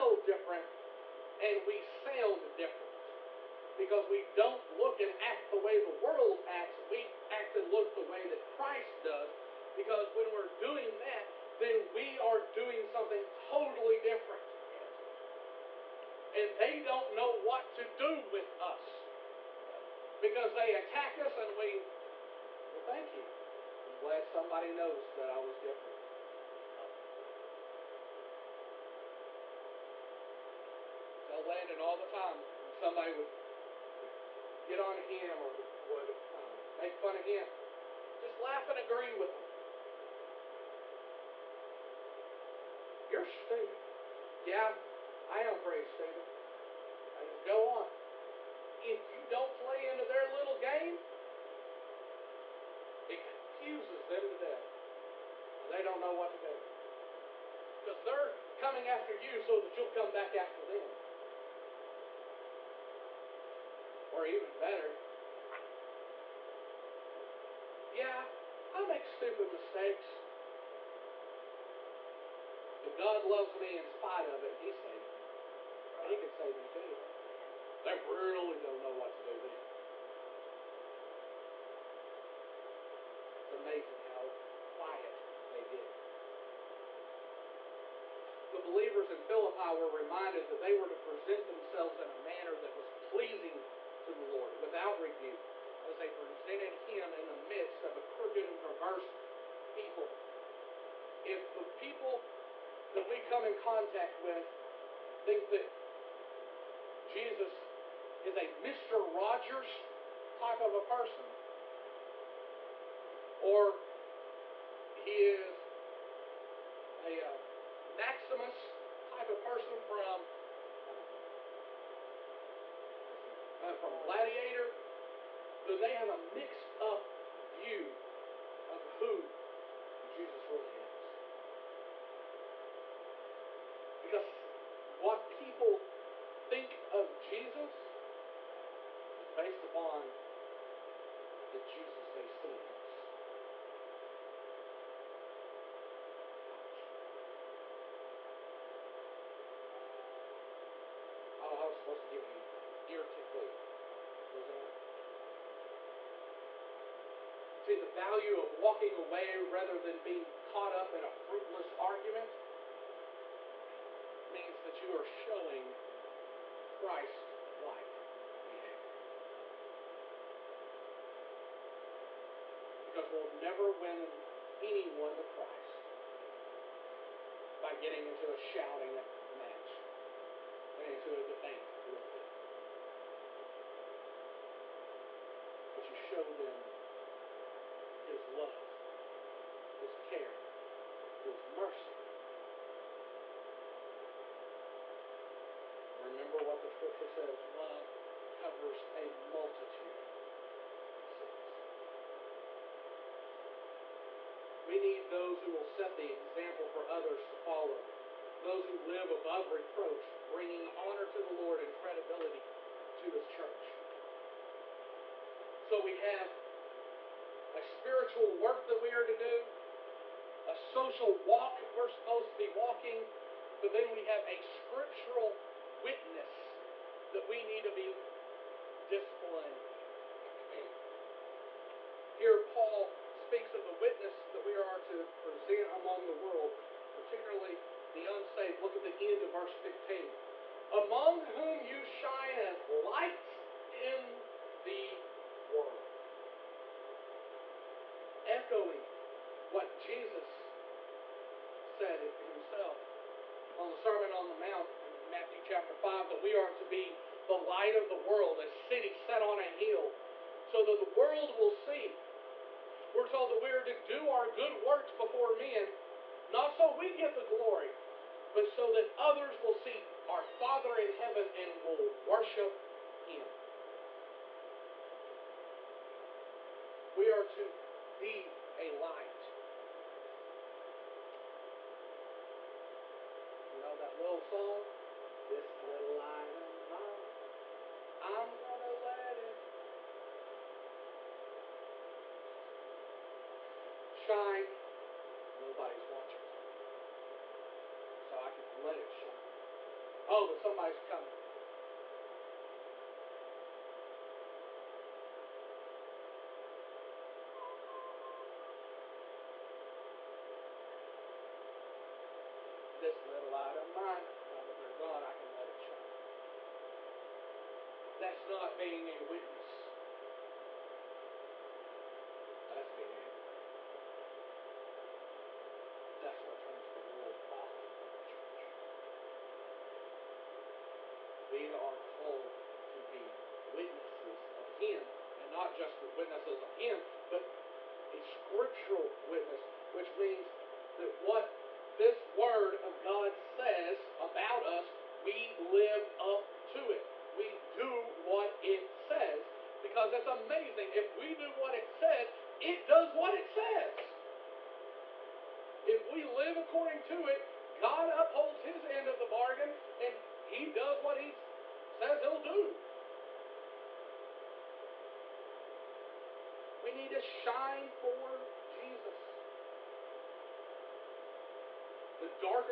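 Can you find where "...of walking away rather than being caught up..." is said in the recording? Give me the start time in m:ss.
2:38.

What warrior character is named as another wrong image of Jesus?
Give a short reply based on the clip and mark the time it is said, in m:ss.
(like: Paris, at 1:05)
Maximus, at 1:57.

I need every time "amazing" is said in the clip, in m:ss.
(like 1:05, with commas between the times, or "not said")
1:23, 5:50.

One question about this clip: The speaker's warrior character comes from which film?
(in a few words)
Gladiator.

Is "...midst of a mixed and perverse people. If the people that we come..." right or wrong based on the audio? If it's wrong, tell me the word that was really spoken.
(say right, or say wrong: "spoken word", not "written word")
wrong: "crooked", not "mixed".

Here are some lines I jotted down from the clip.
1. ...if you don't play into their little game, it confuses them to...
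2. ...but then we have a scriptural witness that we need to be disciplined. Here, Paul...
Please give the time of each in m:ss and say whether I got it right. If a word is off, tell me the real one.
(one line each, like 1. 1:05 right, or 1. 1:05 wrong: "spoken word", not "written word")
1. 0:48 right
2. 3:43 right.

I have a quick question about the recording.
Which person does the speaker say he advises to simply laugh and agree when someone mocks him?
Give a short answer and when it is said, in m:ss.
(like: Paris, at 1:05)
Landon, at 0:31.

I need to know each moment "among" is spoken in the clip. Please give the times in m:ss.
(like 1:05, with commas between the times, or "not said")
3:55, 4:00.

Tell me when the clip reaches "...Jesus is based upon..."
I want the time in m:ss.
2:17.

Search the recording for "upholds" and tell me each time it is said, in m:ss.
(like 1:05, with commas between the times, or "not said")
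5:57.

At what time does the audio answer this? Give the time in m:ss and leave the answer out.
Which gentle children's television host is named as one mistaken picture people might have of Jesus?
1:48.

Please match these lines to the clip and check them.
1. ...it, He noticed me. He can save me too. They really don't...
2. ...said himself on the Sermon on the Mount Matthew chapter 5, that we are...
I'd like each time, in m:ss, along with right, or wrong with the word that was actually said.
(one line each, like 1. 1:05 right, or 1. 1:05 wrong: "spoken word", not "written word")
1. 1:14 wrong: "saved", not "noticed"
2. 4:11 right.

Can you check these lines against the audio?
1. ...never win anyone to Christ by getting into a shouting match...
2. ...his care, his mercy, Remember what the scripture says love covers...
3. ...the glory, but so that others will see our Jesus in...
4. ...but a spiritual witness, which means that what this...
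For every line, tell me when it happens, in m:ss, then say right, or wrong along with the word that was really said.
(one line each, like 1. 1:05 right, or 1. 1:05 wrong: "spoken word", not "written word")
1. 2:53 right
2. 3:09 right
3. 4:27 wrong: "Father", not "Jesus"
4. 5:37 wrong: "scriptural", not "spiritual".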